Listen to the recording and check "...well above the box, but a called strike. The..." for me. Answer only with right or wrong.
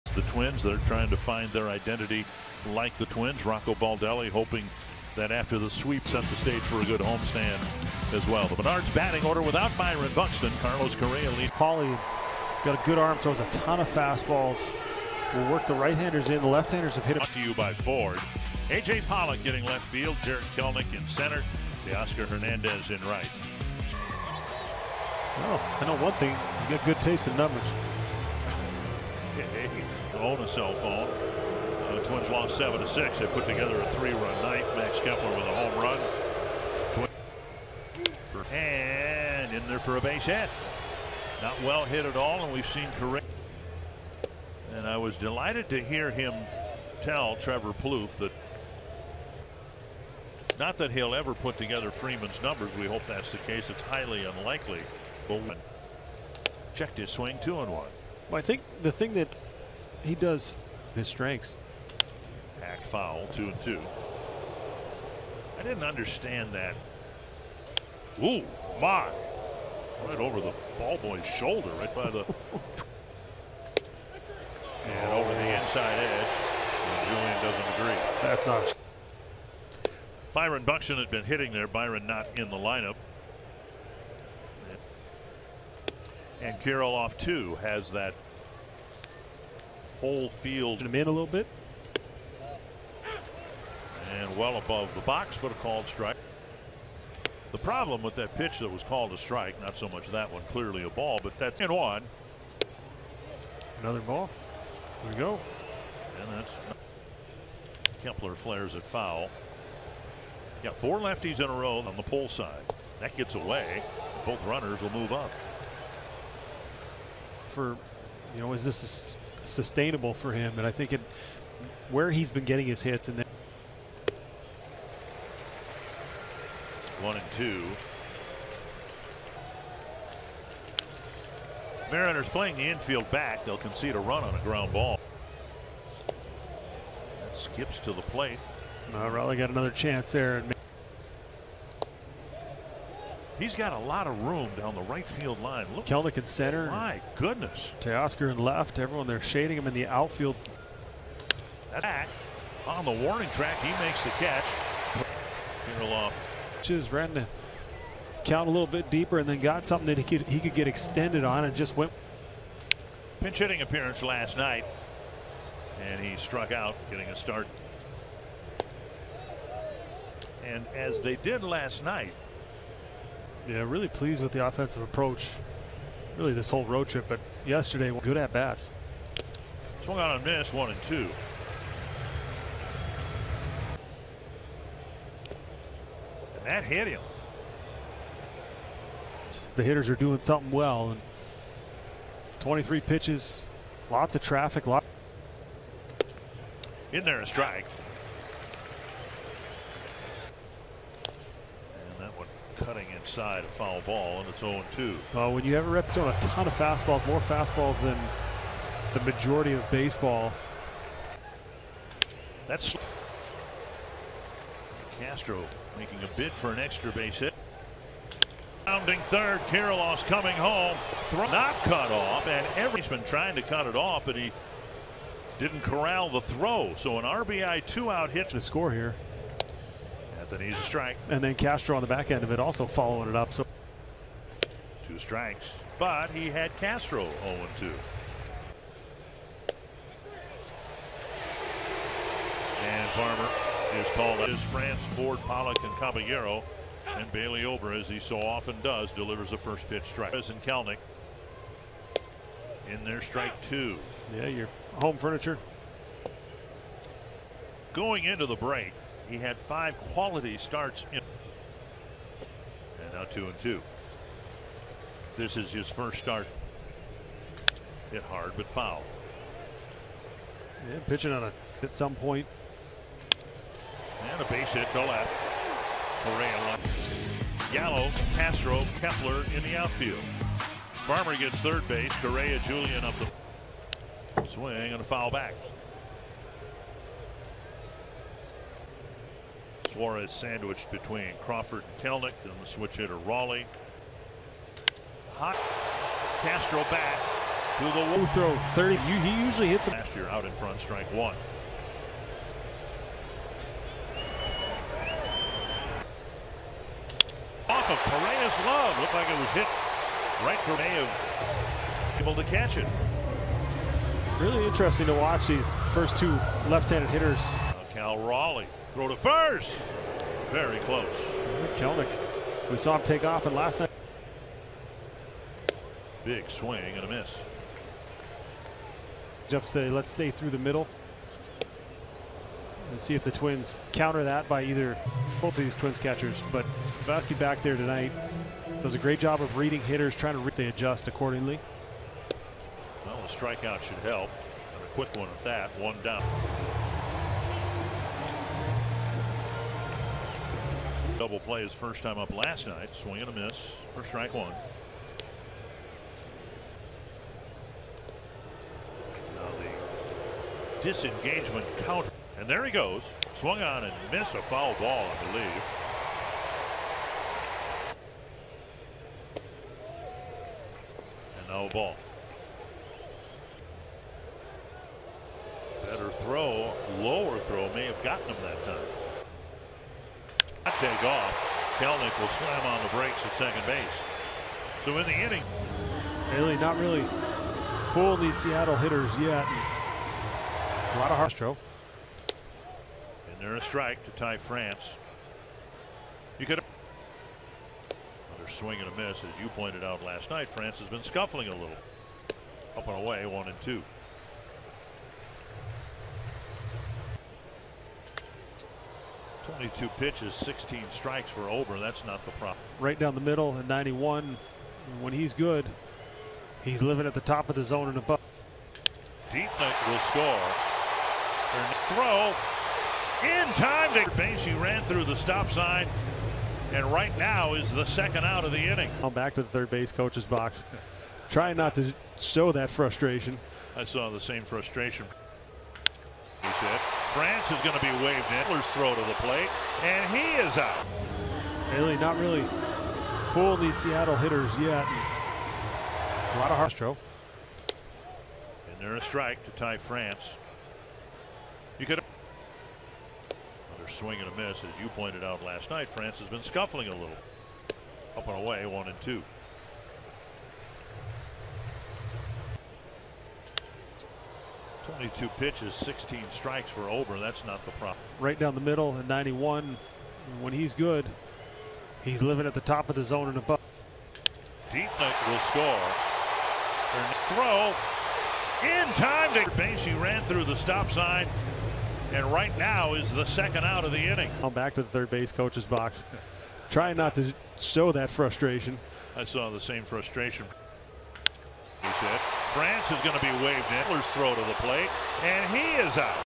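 right.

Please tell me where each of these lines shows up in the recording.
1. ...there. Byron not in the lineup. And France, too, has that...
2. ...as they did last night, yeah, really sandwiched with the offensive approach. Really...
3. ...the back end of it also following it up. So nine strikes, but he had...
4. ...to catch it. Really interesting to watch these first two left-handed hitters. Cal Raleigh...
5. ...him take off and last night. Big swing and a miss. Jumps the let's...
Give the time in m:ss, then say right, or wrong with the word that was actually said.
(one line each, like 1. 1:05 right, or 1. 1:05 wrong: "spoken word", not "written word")
1. 1:21 wrong: "Kirilloff", not "France"
2. 2:50 wrong: "pleased", not "sandwiched"
3. 3:51 wrong: "two", not "nine"
4. 5:12 right
5. 5:22 right.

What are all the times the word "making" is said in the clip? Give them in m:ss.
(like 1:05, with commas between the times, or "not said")
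3:35.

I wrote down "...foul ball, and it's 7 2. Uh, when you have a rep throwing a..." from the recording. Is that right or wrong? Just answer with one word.
wrong.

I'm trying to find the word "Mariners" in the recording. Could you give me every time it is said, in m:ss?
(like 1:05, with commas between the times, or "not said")
2:11.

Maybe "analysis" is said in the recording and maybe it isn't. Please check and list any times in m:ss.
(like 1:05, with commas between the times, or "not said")
not said.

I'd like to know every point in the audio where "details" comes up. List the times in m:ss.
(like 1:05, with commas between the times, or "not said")
not said.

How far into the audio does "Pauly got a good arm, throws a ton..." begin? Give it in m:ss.
0:11.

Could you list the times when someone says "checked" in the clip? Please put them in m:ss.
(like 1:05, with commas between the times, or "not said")
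0:56.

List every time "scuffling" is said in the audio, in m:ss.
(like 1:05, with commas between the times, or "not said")
6:40, 7:36.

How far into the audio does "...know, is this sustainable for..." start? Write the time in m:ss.
1:58.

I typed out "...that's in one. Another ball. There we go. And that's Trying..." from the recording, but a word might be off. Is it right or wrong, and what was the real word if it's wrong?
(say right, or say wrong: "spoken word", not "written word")
wrong: "Kepler", not "Trying".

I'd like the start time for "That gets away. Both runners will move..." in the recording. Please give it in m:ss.
1:52.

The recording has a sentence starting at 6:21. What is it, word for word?
Kelenic will slam on the brakes at second base.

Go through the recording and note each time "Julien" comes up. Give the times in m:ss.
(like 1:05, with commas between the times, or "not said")
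1:17, 4:42.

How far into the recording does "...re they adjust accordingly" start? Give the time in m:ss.
5:40.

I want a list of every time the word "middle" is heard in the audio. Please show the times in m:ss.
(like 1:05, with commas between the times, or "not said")
5:30, 6:53, 7:48.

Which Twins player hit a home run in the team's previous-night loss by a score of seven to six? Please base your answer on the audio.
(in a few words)
Max Kepler.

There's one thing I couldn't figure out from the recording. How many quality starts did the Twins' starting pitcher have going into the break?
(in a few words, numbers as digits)
5.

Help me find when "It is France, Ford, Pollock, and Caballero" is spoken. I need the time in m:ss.
4:04.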